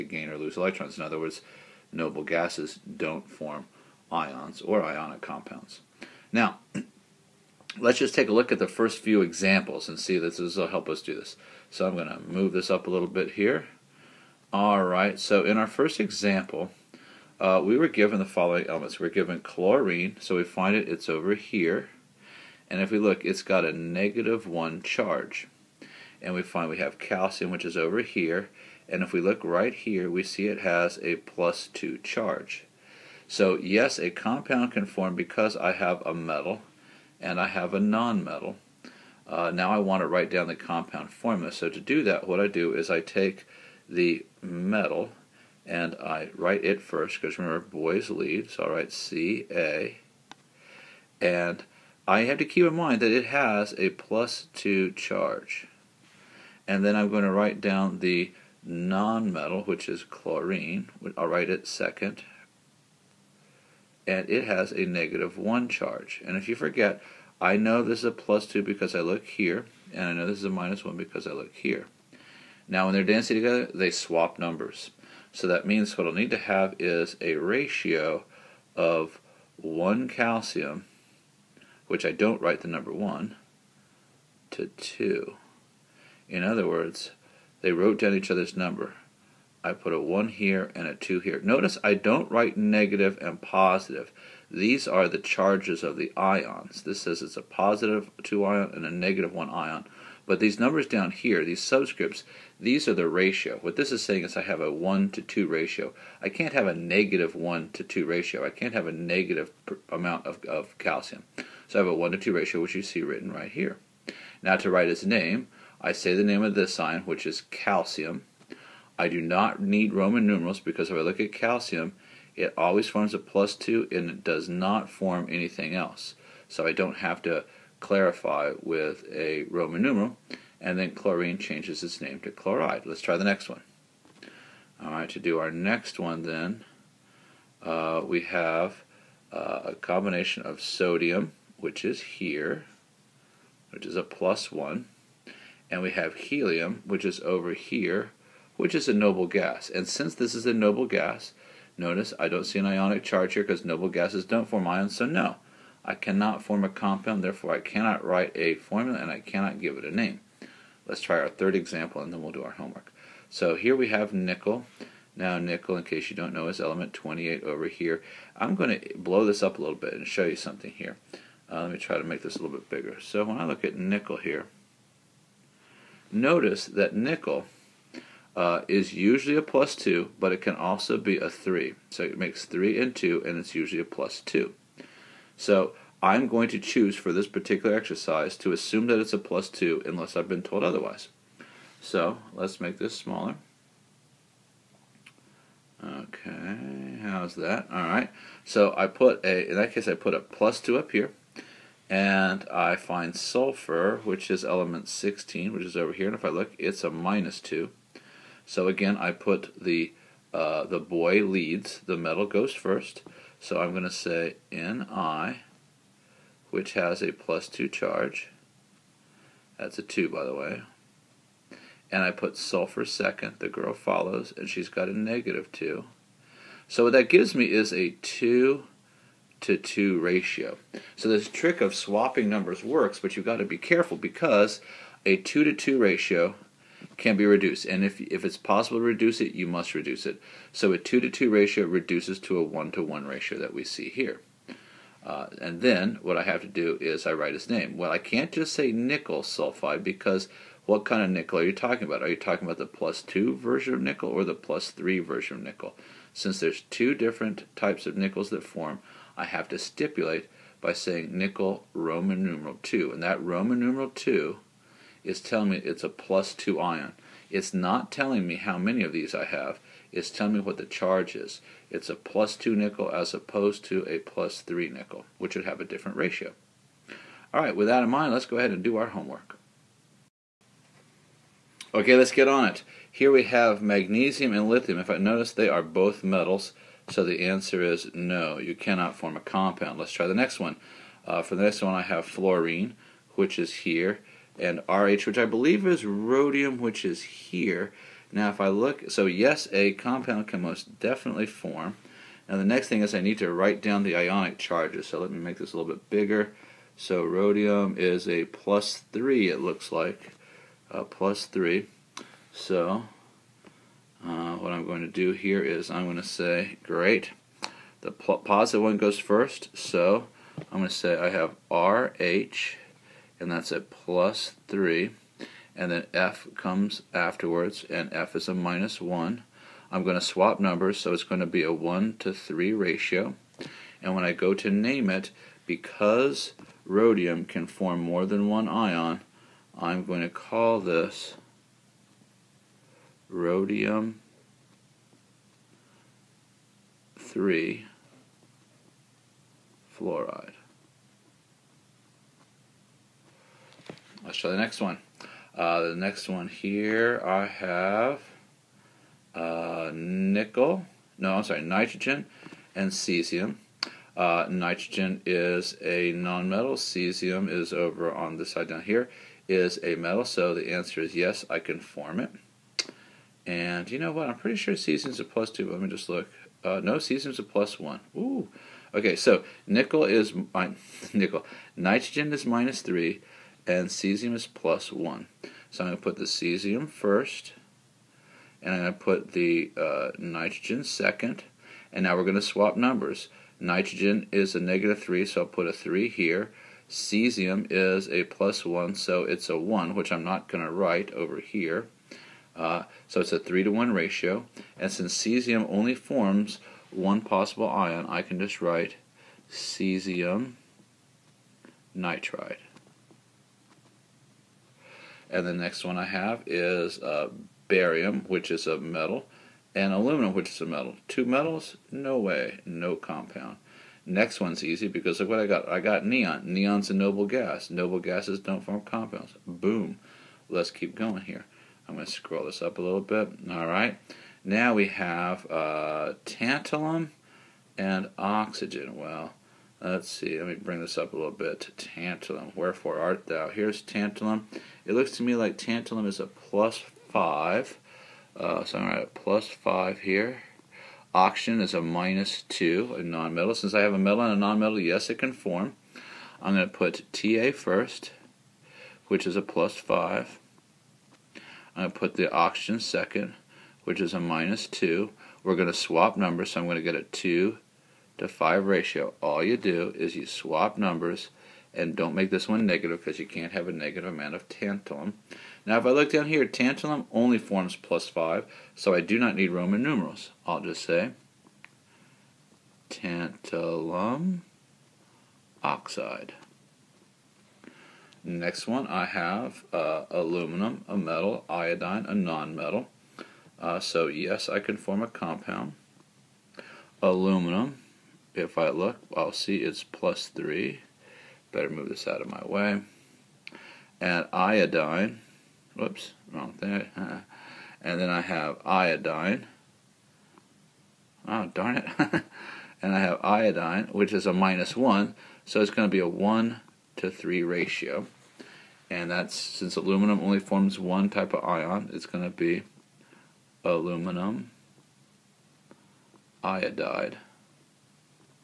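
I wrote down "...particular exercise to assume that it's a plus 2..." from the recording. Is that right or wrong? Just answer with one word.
right.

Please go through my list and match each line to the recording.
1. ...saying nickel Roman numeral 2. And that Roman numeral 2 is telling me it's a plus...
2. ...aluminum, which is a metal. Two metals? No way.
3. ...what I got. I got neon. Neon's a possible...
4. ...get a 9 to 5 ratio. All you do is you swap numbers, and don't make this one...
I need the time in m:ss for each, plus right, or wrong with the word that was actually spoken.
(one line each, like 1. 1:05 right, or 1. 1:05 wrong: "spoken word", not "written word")
1. 4:20 right
2. 6:59 right
3. 7:05 wrong: "noble", not "possible"
4. 7:46 wrong: "2", not "9".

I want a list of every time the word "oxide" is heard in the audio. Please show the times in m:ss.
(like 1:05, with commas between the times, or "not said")
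8:05.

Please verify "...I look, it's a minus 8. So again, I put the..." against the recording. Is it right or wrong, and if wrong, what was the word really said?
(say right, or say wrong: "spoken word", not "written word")
wrong: "2", not "8".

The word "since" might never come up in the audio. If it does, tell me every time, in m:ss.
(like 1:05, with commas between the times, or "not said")
2:29, 4:16, 6:44, 7:33, 8:39.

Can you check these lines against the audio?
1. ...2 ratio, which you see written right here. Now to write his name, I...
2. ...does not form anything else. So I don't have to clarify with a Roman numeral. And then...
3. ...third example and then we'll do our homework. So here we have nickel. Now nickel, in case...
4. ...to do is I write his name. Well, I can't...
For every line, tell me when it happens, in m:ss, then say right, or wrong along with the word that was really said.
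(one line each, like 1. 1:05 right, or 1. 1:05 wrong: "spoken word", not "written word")
1. 1:52 right
2. 2:04 right
3. 2:41 right
4. 4:06 right.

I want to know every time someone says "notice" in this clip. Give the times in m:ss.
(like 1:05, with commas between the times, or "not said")
1:31, 2:31, 2:56, 4:44.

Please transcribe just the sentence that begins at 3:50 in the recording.
So this trick of swapping numbers works, but you've got to be careful because a 2 to 2 ratio can be reduced.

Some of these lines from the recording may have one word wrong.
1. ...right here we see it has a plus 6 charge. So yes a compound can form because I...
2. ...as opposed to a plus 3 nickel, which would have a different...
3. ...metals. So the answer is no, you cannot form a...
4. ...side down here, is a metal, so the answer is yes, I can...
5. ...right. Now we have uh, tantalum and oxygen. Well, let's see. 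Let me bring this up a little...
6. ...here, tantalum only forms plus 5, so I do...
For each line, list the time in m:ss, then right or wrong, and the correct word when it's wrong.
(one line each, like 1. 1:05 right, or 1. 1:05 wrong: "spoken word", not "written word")
1. 0:29 wrong: "2", not "6"
2. 4:32 right
3. 4:46 right
4. 6:08 right
5. 7:13 right
6. 7:56 right.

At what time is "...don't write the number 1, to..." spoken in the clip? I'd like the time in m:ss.
1:22.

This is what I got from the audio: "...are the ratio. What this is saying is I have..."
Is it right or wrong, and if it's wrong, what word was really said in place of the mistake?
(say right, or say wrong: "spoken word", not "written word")
right.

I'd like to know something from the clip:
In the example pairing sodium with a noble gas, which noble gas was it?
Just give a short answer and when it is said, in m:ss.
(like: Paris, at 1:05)
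Helium, at 2:26.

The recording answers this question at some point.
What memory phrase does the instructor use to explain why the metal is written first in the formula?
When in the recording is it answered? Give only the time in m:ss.
0:47.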